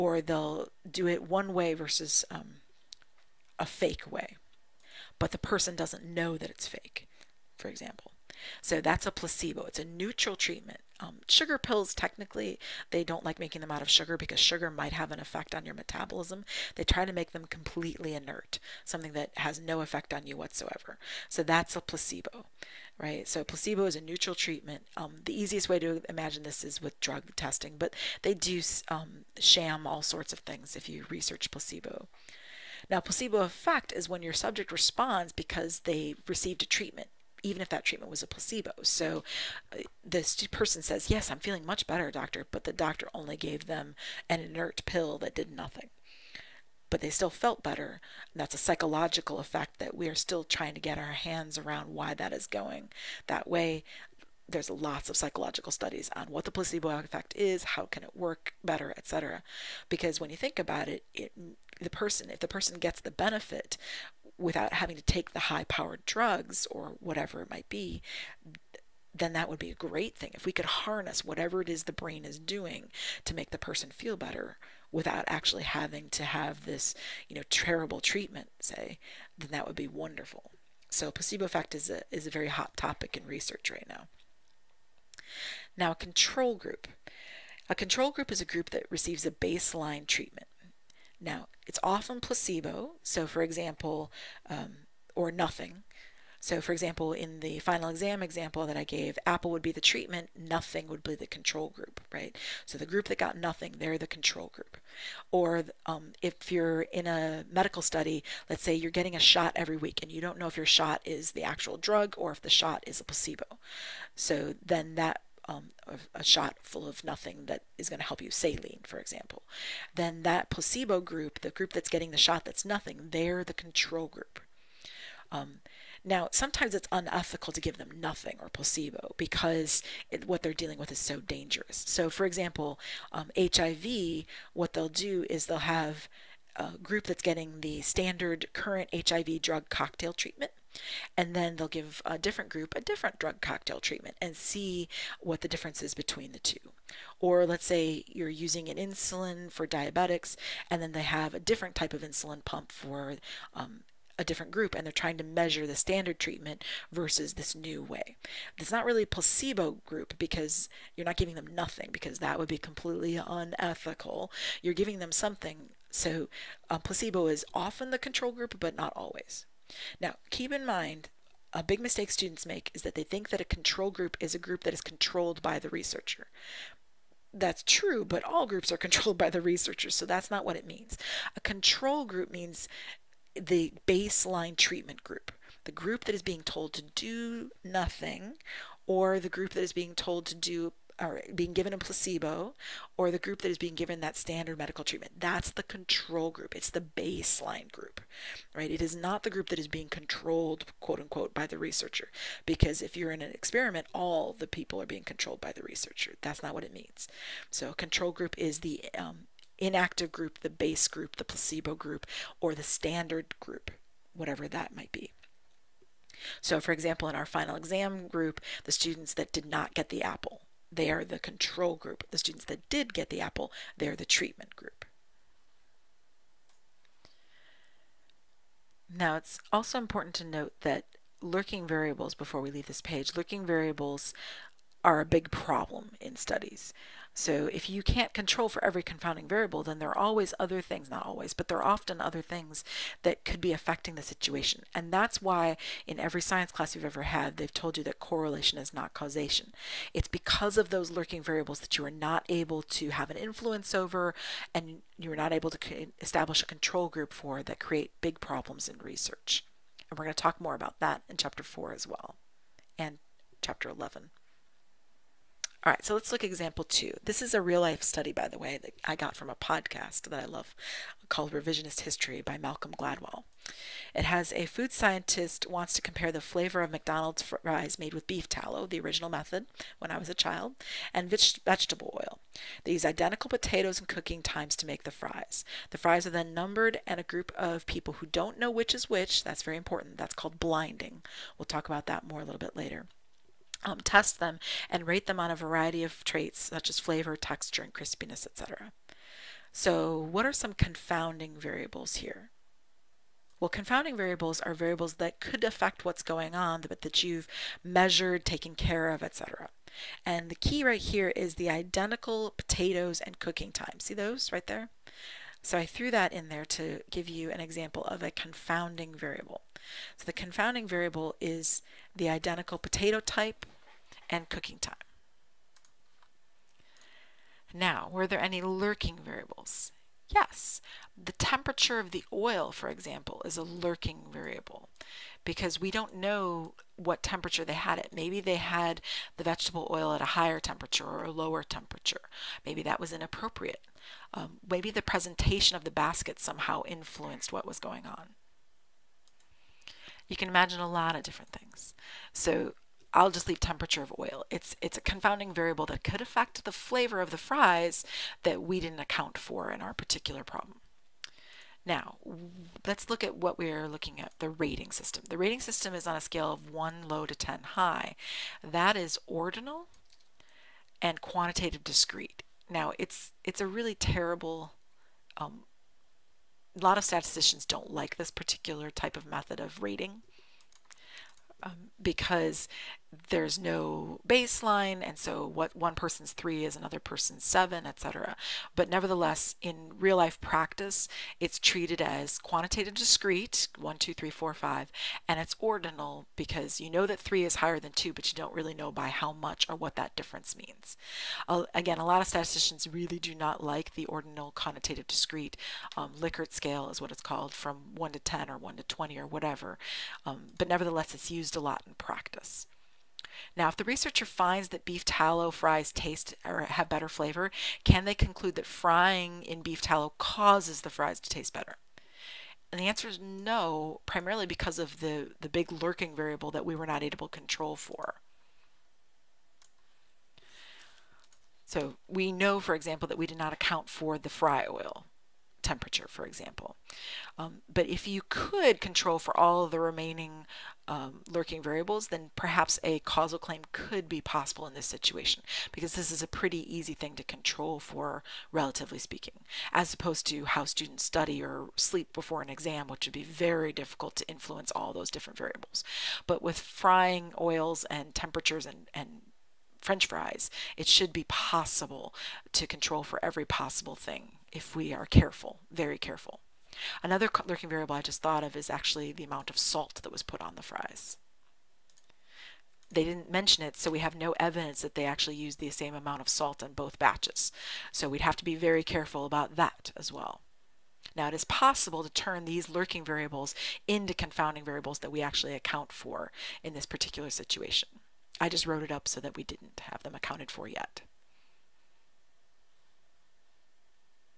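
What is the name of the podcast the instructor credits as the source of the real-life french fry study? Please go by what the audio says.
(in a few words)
Revisionist History.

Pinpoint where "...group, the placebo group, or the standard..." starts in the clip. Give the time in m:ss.
3:30.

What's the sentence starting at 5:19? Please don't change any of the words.
So the confounding variable is the identical potato type and cooking time.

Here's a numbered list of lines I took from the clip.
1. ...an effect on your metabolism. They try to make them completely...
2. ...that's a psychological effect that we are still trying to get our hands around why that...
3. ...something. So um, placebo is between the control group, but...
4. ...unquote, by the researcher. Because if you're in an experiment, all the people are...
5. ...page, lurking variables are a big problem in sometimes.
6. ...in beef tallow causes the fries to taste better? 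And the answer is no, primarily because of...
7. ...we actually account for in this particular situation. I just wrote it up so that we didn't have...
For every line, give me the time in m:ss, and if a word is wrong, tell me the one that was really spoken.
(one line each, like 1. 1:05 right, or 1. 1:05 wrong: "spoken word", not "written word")
1. 0:15 right
2. 0:48 right
3. 2:45 wrong: "often", not "between"
4. 3:21 right
5. 3:52 wrong: "studies", not "sometimes"
6. 6:59 right
7. 8:04 right.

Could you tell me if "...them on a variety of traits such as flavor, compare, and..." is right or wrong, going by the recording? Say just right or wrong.
wrong.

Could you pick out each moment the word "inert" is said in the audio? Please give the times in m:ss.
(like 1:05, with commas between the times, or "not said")
0:18, 0:44.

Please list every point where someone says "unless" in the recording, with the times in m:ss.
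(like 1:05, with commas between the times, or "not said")
not said.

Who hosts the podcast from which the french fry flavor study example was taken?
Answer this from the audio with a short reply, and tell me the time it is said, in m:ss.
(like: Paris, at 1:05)
Malcolm Gladwell, at 4:32.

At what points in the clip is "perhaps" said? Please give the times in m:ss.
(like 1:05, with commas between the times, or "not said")
7:22.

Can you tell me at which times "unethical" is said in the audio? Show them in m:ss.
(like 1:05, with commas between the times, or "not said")
2:06, 2:43.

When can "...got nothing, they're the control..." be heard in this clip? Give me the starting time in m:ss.
1:43.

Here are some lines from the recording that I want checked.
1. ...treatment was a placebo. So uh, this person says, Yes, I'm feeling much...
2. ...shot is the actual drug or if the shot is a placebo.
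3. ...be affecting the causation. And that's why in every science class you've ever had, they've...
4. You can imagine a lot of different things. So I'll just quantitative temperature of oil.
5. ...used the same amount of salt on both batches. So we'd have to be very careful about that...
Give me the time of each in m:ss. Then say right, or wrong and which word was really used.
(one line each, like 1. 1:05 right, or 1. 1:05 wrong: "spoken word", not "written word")
1. 0:37 right
2. 1:50 right
3. 4:03 wrong: "situation", not "causation"
4. 5:50 wrong: "leave", not "quantitative"
5. 7:55 right.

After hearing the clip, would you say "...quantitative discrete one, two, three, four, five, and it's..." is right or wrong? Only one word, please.
right.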